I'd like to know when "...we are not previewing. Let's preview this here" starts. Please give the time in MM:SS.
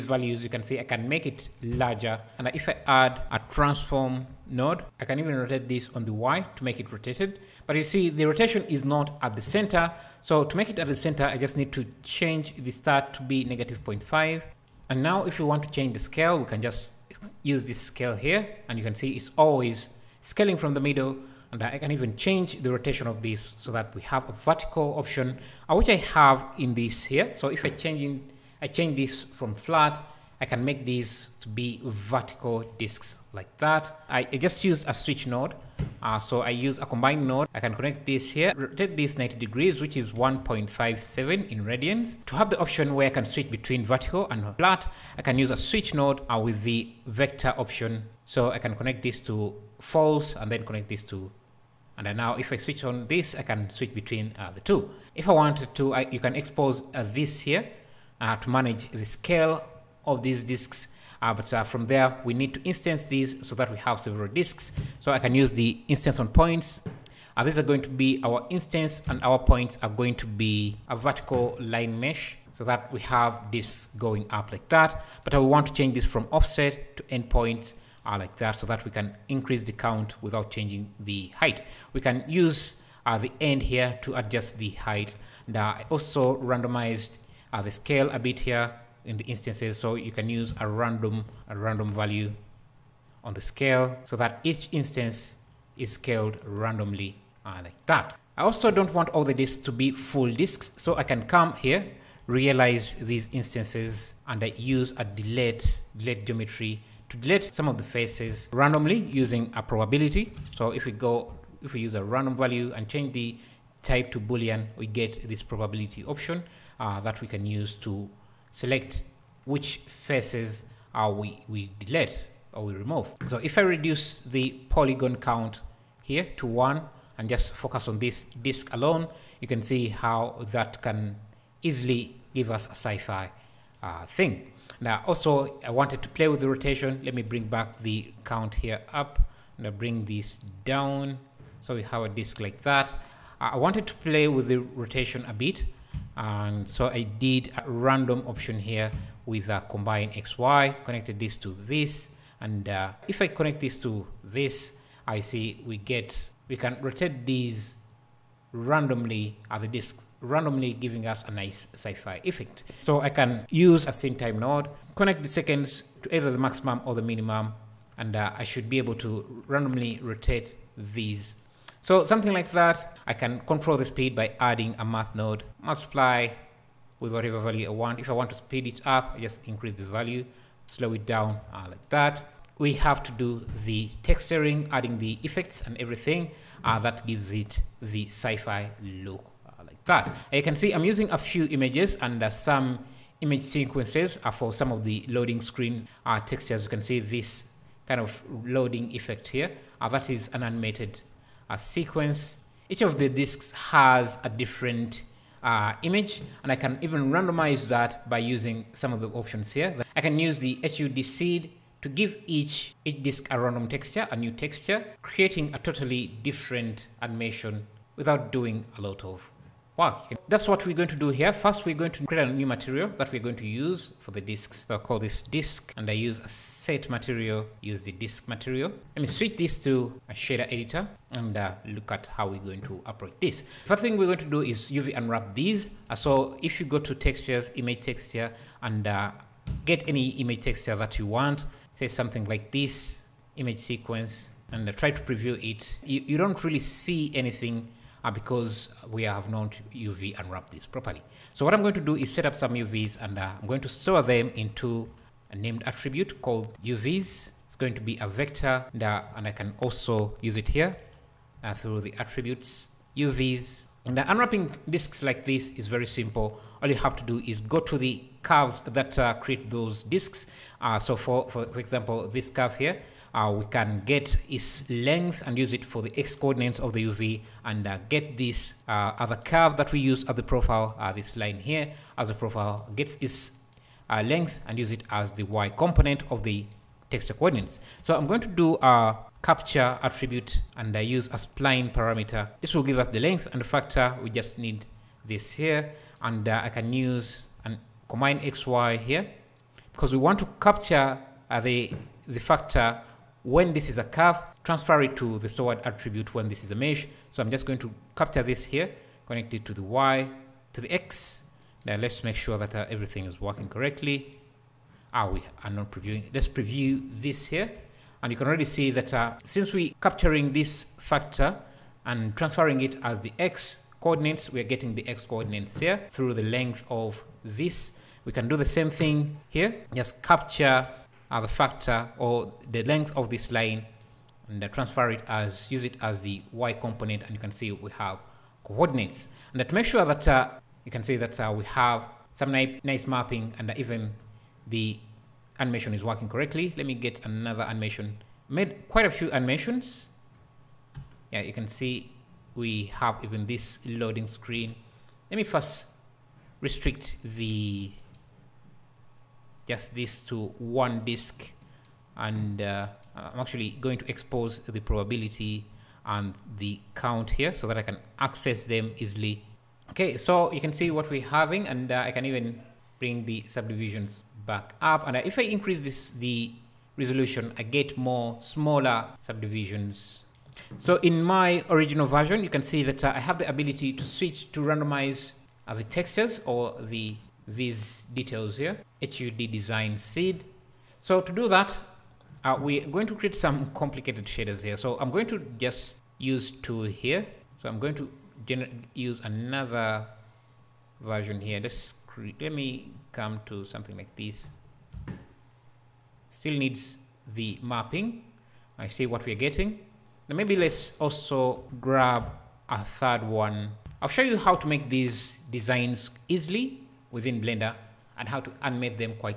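05:15.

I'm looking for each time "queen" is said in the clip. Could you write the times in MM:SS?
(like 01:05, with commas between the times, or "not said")
not said.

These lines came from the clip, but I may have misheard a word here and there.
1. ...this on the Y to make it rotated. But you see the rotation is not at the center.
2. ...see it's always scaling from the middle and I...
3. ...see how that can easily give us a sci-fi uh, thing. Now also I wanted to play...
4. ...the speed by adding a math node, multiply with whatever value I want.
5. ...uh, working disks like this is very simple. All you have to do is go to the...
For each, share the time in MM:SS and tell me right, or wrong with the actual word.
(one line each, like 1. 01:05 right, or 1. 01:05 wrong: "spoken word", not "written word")
1. 00:05 right
2. 00:18 right
3. 02:09 right
4. 02:53 right
5. 04:23 wrong: "unwrapping", not "working".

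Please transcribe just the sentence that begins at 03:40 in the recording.
That's what we're going to do here.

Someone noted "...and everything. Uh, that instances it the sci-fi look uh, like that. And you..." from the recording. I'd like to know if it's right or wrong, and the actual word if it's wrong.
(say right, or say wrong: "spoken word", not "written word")
wrong: "gives", not "instances".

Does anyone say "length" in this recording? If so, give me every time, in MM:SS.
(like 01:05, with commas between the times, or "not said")
04:34, 04:44, 04:52, 05:26, 05:32.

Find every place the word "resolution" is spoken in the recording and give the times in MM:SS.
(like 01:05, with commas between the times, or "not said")
06:16.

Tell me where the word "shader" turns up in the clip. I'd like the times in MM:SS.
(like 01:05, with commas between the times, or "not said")
03:50, 06:34.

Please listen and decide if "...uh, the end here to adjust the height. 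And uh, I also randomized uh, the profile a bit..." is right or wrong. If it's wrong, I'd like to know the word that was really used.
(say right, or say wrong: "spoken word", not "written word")
wrong: "scale", not "profile".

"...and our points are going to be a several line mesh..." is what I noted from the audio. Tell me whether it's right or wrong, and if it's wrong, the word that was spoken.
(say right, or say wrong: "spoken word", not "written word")
wrong: "vertical", not "several".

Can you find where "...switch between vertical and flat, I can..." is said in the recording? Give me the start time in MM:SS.
00:43.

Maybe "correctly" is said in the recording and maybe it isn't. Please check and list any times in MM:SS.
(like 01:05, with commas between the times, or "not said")
05:13, 05:46.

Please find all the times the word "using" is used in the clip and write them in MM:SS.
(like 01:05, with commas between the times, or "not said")
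01:48, 03:10, 03:28.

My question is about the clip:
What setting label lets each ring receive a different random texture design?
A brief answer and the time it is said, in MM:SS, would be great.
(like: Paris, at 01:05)
HUD design seed, at 06:28.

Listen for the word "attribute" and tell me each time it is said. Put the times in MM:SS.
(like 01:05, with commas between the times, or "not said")
04:15, 04:21, 04:49, 05:05.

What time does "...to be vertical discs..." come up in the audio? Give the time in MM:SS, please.
00:31.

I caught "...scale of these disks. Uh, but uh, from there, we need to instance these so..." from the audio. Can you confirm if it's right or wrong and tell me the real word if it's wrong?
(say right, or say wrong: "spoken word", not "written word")
right.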